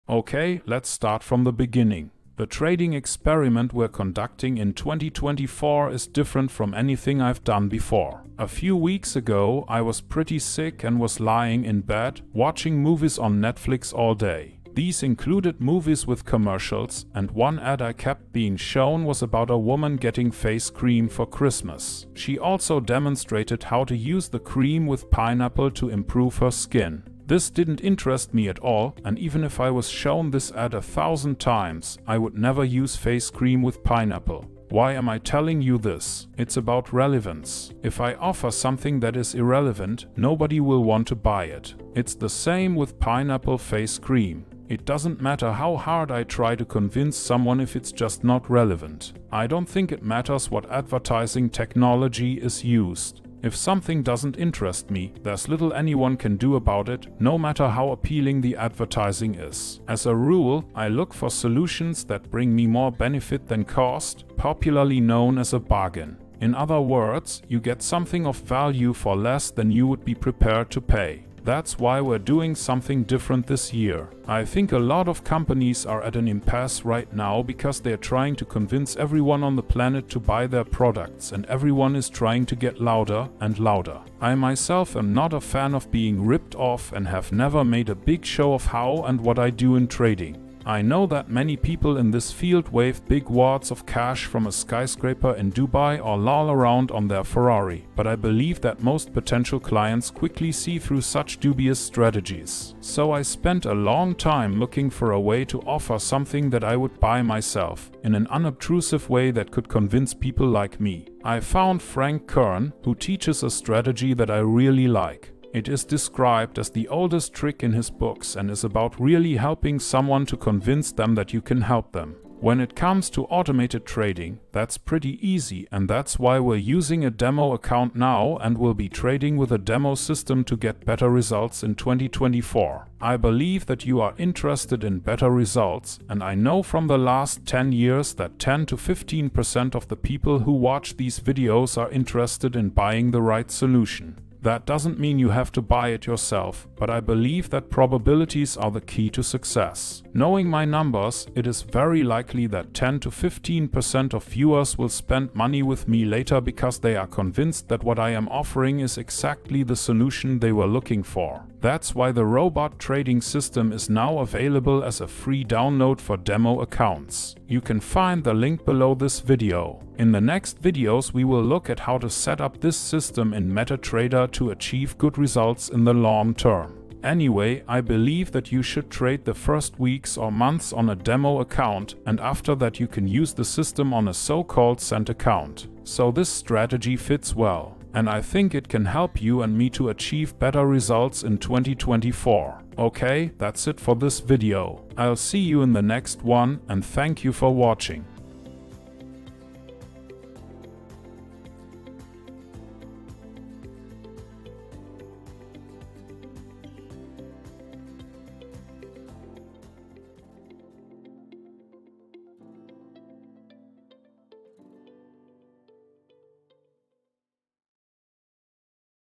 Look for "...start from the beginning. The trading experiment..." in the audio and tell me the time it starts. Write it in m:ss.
0:00.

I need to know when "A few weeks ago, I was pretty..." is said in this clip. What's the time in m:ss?
0:08.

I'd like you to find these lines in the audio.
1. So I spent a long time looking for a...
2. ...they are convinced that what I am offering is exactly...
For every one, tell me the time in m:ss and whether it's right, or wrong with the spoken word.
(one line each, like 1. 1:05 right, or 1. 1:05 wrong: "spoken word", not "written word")
1. 1:42 right
2. 2:36 right.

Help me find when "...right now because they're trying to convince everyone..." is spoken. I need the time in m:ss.
1:16.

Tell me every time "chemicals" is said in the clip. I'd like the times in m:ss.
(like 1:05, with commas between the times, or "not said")
not said.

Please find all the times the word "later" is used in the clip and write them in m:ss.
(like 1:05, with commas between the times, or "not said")
2:36.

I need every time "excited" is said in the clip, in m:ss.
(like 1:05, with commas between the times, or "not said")
not said.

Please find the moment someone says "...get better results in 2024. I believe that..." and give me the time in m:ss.
2:10.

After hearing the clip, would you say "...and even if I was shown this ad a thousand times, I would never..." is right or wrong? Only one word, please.
right.